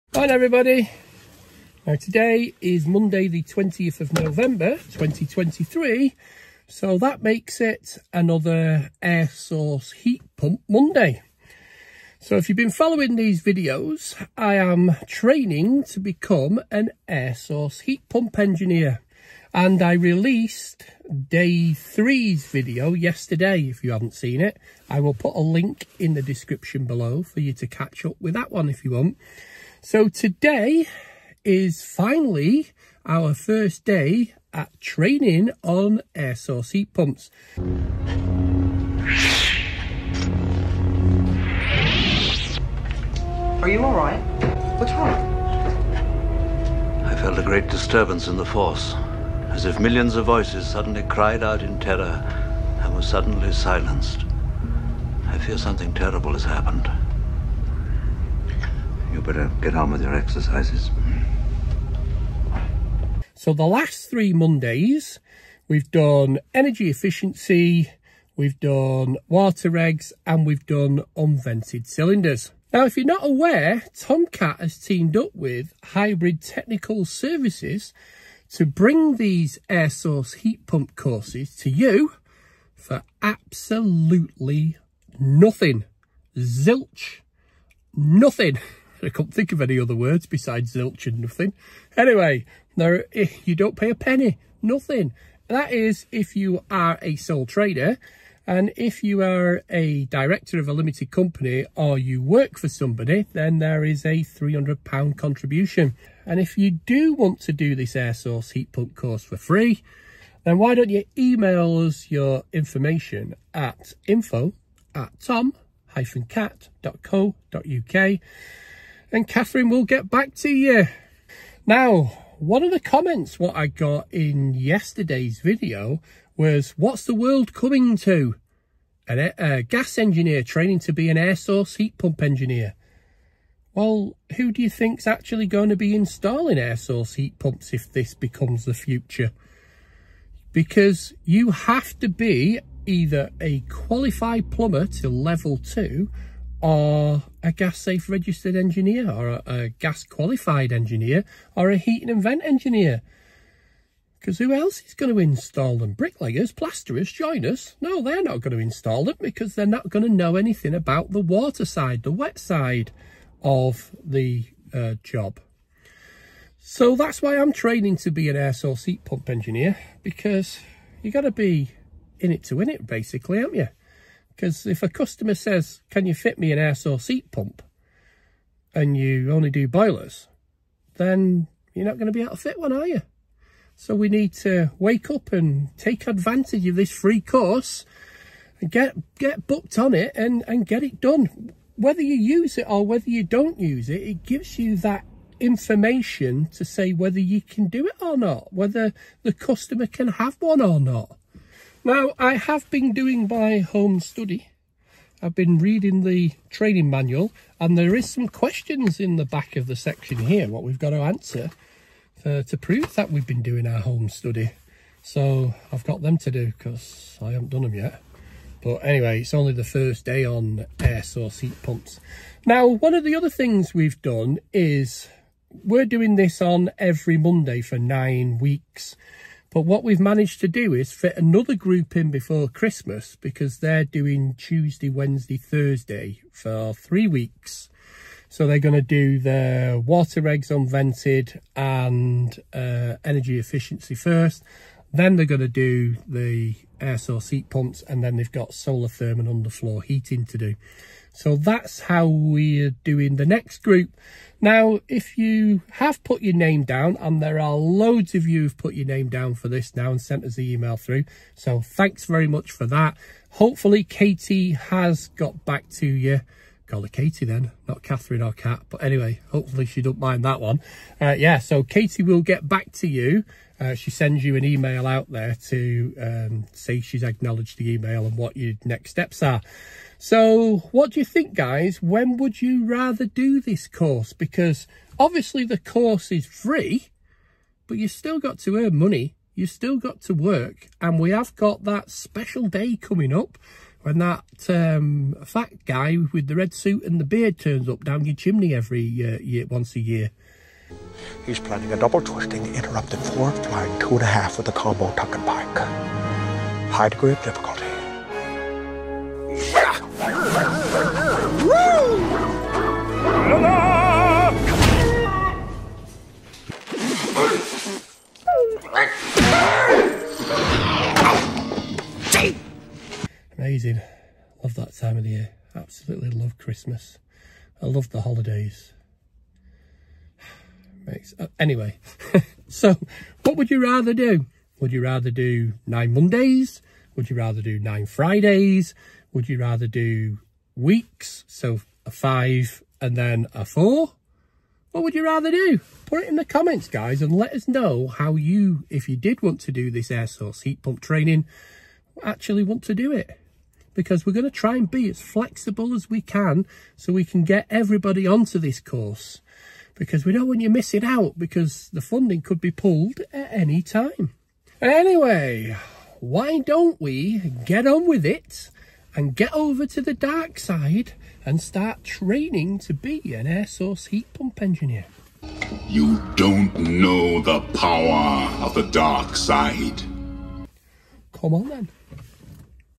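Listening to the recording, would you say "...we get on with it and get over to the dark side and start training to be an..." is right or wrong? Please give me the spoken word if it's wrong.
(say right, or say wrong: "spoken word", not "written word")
right.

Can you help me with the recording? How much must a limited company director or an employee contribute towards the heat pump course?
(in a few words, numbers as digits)
£300.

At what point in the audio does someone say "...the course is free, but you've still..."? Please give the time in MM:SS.
04:45.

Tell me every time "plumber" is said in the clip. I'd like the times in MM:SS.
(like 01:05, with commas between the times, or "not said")
02:24.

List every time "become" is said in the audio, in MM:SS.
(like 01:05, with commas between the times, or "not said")
00:16, 02:18.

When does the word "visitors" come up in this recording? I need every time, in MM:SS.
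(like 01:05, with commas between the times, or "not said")
not said.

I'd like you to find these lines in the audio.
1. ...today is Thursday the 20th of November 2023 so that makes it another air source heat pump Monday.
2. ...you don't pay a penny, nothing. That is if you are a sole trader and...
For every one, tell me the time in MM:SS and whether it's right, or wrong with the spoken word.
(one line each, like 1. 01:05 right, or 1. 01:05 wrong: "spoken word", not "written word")
1. 00:01 wrong: "Monday", not "Thursday"
2. 01:33 right.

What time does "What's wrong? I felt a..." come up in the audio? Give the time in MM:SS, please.
00:44.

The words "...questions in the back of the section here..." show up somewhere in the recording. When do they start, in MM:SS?
03:28.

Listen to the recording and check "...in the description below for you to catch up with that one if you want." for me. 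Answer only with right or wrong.
right.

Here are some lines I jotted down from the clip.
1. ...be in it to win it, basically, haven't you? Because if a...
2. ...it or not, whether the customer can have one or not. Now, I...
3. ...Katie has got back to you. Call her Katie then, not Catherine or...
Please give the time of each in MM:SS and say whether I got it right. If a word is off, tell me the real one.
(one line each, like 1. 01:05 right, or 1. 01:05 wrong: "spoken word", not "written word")
1. 02:51 right
2. 03:17 right
3. 04:23 right.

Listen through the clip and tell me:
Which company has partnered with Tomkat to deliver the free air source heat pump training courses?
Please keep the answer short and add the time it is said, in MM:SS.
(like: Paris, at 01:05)
Hybrid Technical Services, at 01:15.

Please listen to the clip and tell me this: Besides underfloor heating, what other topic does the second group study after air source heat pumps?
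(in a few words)
Solar thermal.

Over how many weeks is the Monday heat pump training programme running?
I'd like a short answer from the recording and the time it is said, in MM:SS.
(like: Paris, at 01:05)
9, at 03:47.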